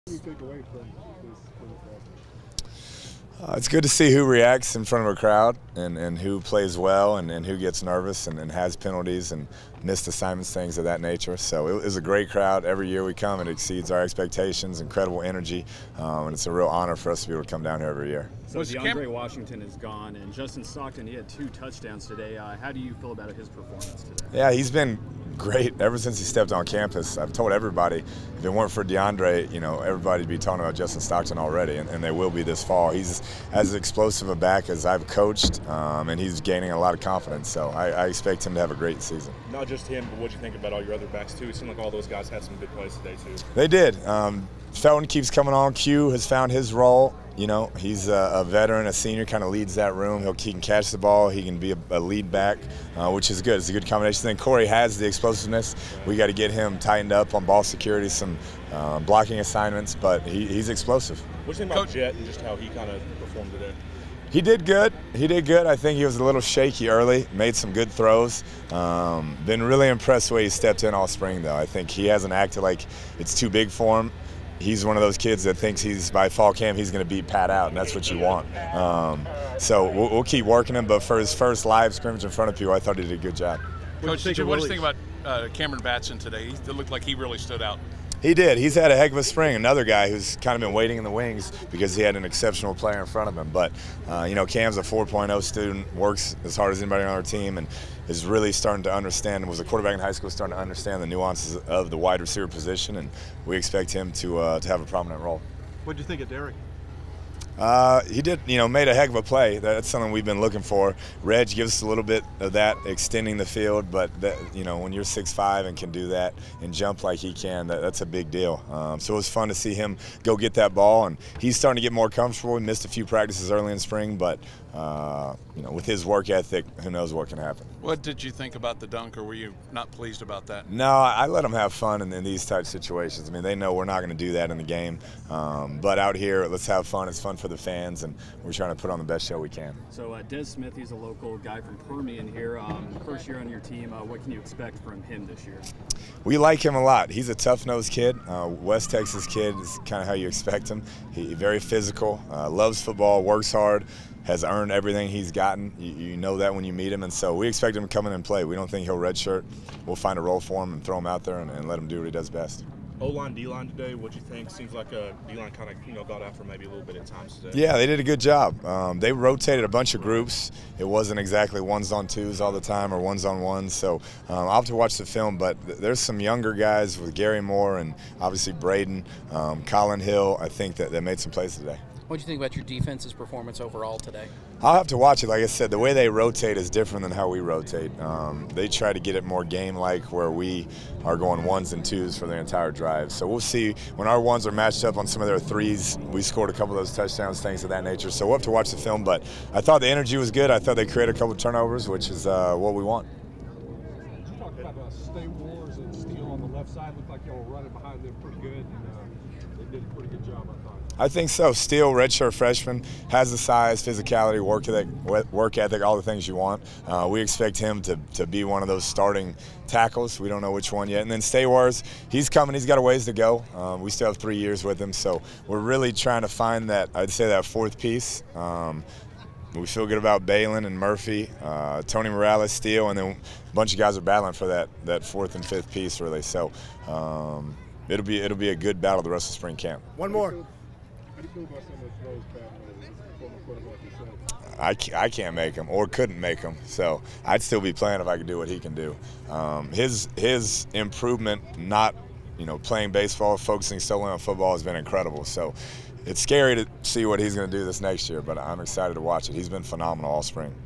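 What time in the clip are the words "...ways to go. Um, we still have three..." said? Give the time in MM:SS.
03:42.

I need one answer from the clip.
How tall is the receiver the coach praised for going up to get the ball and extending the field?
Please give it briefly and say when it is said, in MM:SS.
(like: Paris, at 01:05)
6'5, at 01:55.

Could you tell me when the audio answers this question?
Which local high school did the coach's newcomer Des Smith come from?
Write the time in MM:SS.
02:21.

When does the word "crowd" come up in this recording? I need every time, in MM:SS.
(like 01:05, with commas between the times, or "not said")
00:05, 00:12.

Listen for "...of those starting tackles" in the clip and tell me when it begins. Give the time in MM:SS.
03:38.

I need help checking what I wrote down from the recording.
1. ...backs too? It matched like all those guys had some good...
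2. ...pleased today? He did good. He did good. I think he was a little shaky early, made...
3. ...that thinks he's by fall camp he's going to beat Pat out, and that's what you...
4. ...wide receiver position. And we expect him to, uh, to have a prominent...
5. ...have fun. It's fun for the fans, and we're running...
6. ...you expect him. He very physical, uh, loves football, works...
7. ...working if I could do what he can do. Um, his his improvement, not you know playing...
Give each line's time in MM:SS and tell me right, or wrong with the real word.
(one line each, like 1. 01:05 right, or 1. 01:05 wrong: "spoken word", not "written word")
1. 00:41 wrong: "seemed", not "matched"
2. 01:03 wrong: "performed", not "pleased"
3. 01:15 right
4. 01:41 right
5. 02:16 wrong: "trying", not "running"
6. 02:30 right
7. 04:07 wrong: "playing", not "working".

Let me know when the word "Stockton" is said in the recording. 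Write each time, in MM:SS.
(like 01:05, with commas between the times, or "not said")
00:20, 00:30.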